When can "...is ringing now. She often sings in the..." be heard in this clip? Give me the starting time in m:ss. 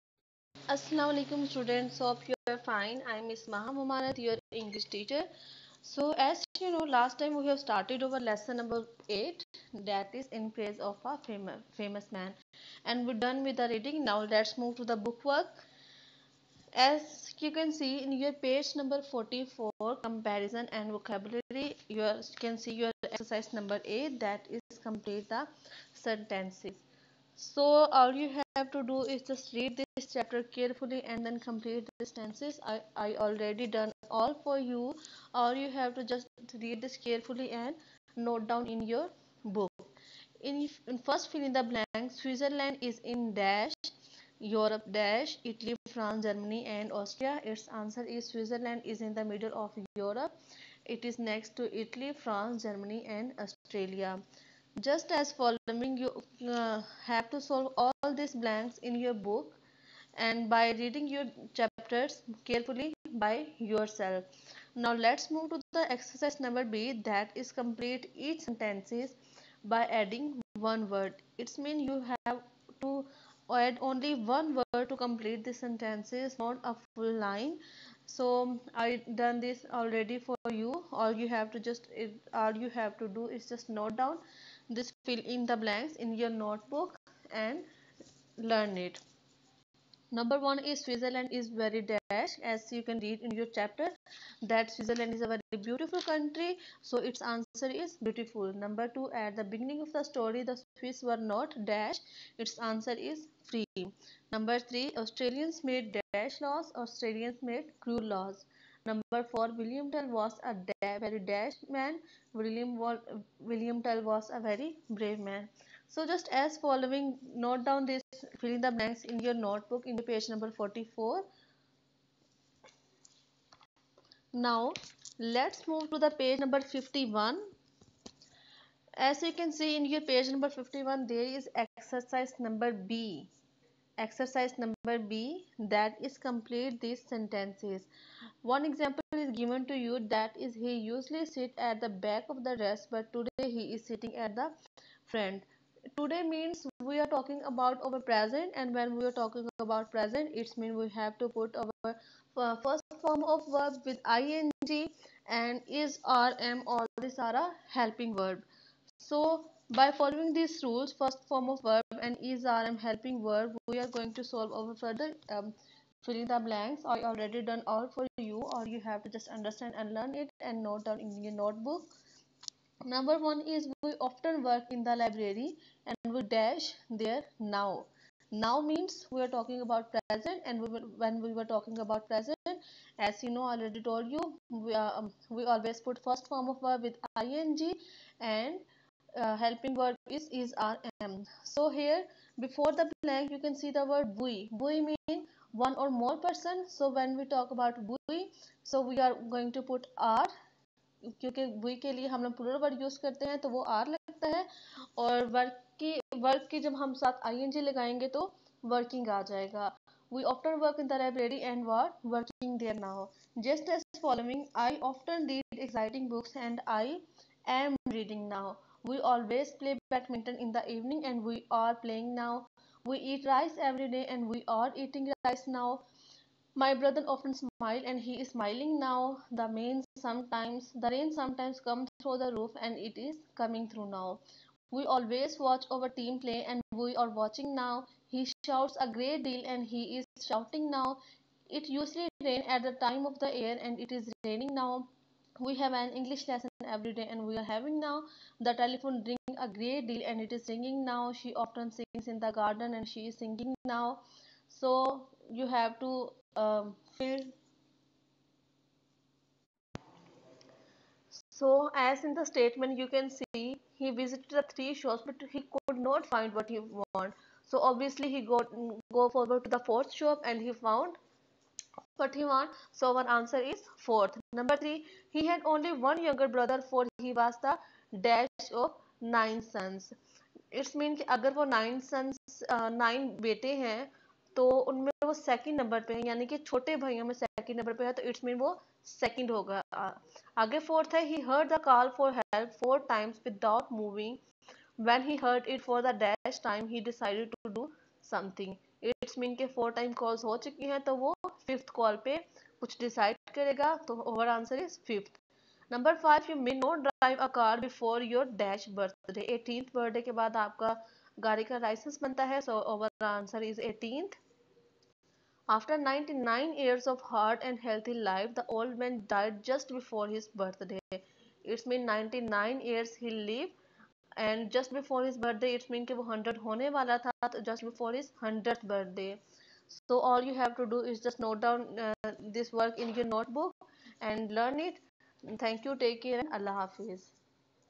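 4:10.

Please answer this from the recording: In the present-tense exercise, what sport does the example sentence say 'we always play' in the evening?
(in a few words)
badminton.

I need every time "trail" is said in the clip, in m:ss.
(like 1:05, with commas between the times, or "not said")
not said.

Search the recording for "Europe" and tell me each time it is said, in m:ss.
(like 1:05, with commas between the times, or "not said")
0:44, 0:49.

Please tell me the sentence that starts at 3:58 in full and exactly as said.
He shouts a great deal and he is shouting now.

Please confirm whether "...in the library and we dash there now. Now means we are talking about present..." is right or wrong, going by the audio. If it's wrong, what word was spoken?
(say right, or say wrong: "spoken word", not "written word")
right.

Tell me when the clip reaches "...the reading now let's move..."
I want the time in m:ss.
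0:13.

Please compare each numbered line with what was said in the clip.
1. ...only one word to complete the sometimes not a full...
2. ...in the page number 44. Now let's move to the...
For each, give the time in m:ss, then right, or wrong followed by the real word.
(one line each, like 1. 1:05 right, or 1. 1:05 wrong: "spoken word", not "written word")
1. 1:13 wrong: "sentences", not "sometimes"
2. 1:59 right.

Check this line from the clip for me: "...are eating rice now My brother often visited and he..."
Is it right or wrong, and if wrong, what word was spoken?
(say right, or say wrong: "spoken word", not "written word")
wrong: "smiled", not "visited".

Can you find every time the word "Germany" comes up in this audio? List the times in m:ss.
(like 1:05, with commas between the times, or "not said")
0:46, 0:52.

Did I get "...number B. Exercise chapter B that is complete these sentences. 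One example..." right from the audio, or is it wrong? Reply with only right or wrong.
wrong.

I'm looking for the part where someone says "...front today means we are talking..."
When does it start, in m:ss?
2:25.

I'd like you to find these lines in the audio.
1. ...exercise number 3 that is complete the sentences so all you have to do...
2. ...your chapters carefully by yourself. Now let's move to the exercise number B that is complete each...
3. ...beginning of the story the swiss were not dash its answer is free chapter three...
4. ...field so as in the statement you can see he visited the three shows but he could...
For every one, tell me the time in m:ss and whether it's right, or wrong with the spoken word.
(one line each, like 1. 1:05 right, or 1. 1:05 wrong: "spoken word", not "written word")
1. 0:23 wrong: "8", not "3"
2. 1:01 right
3. 1:39 wrong: "number", not "chapter"
4. 4:16 right.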